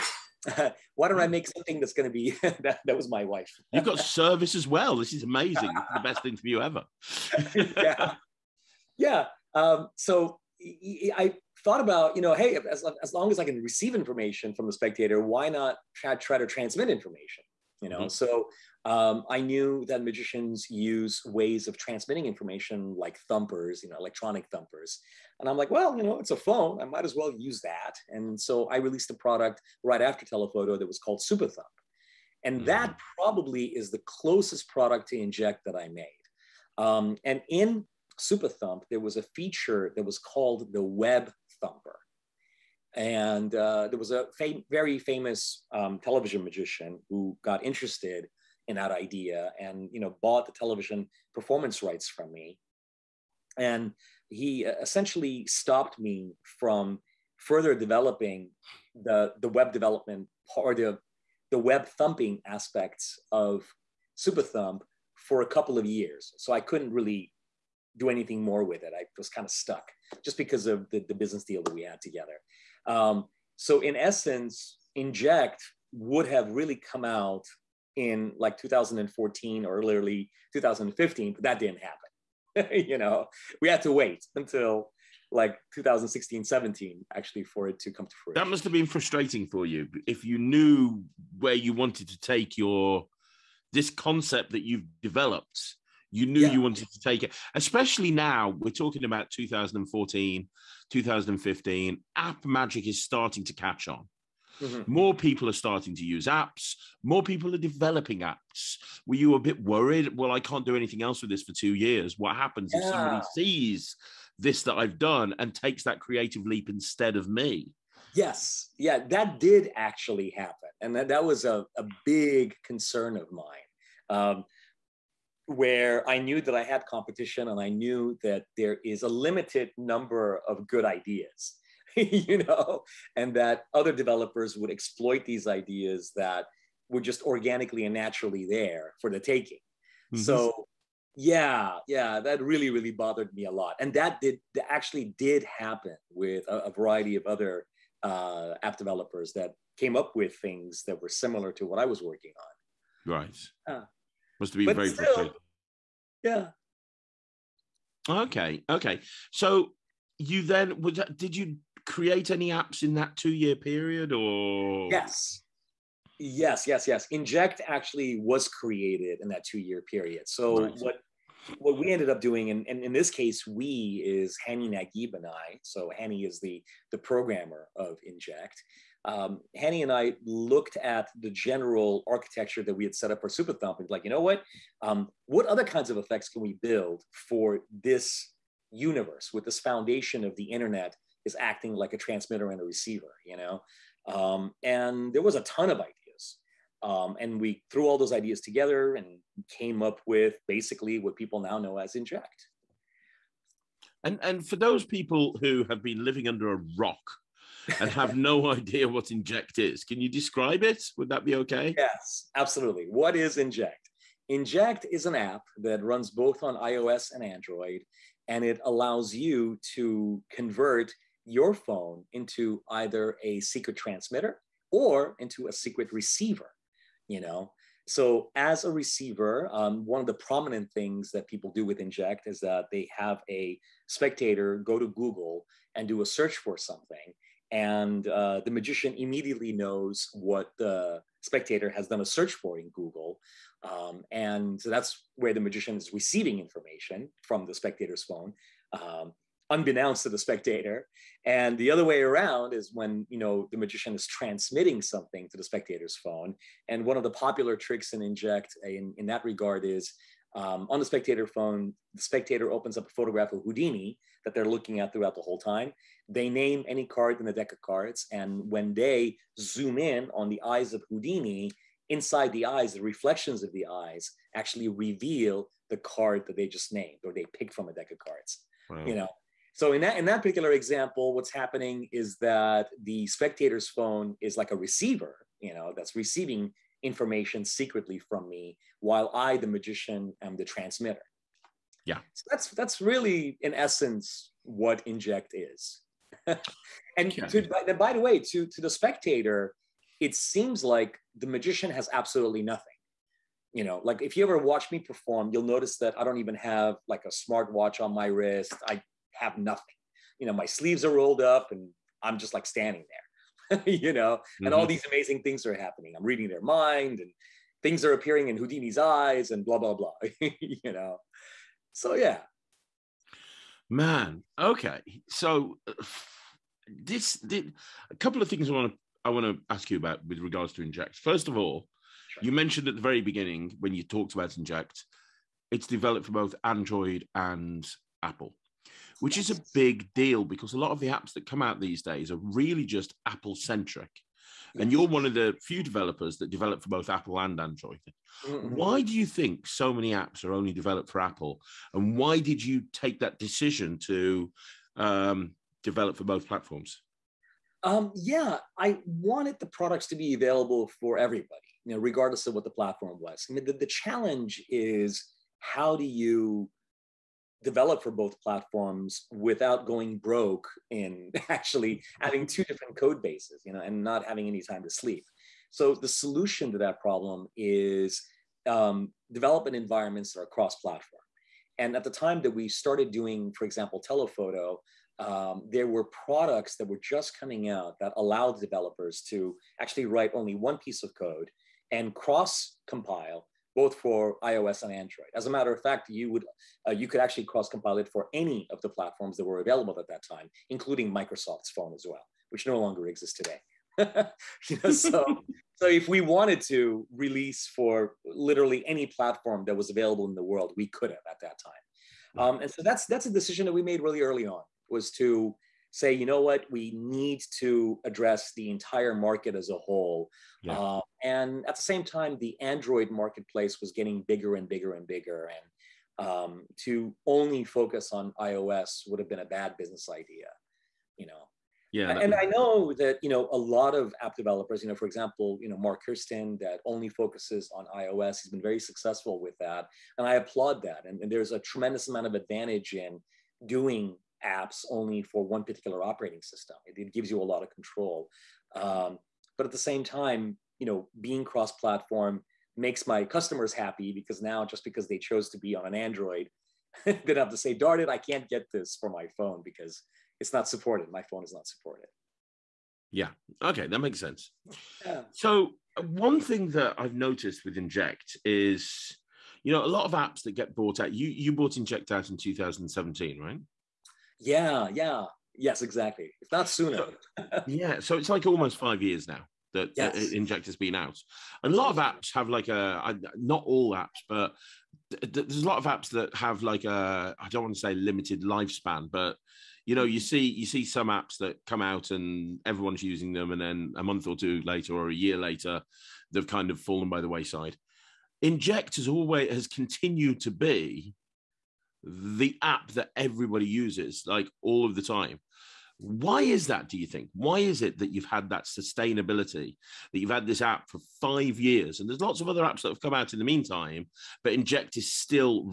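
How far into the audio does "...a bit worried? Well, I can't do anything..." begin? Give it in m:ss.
1:49.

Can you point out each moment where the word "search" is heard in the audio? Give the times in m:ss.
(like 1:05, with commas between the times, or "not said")
3:56, 4:02.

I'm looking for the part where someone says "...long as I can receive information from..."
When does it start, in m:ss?
0:13.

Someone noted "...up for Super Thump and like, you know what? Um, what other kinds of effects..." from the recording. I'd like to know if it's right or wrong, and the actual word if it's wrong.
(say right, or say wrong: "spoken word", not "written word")
right.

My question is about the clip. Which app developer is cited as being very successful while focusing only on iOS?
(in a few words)
Marc Kerstein.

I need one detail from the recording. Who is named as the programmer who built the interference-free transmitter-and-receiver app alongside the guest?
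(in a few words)
Hani Nagib.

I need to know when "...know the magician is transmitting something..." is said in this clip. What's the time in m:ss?
4:13.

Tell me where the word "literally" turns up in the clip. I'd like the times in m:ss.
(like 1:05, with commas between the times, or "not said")
1:19, 6:48.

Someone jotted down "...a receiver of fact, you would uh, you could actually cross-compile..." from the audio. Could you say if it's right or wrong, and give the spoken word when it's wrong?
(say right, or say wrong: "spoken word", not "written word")
wrong: "matter", not "receiver".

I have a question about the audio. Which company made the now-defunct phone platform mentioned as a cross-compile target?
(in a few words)
Microsoft.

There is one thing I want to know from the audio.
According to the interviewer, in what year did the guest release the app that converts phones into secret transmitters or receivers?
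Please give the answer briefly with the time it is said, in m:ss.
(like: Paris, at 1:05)
2017, at 7:52.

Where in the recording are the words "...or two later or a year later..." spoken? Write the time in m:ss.
8:14.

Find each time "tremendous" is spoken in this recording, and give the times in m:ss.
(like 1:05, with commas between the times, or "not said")
7:21.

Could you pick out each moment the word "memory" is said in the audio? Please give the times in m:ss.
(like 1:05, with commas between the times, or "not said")
not said.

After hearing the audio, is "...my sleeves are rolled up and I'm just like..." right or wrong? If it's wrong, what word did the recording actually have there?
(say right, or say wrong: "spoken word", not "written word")
right.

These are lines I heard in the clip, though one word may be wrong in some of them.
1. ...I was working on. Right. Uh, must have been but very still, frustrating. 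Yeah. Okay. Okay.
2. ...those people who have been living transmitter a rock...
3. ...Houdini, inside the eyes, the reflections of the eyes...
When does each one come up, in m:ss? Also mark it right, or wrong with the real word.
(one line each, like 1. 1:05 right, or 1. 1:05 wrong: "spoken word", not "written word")
1. 2:31 right
2. 3:24 wrong: "under", not "transmitter"
3. 4:30 right.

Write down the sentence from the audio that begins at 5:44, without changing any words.
And you're one of the few developers that develop for both Apple and Android.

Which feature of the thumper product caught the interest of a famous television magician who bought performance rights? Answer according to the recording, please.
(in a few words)
web thumper.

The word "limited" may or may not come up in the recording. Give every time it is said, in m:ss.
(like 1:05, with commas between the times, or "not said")
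2:09, 8:07.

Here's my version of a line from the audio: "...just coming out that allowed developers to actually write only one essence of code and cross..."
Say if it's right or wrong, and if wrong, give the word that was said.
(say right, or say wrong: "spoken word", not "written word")
wrong: "piece", not "essence".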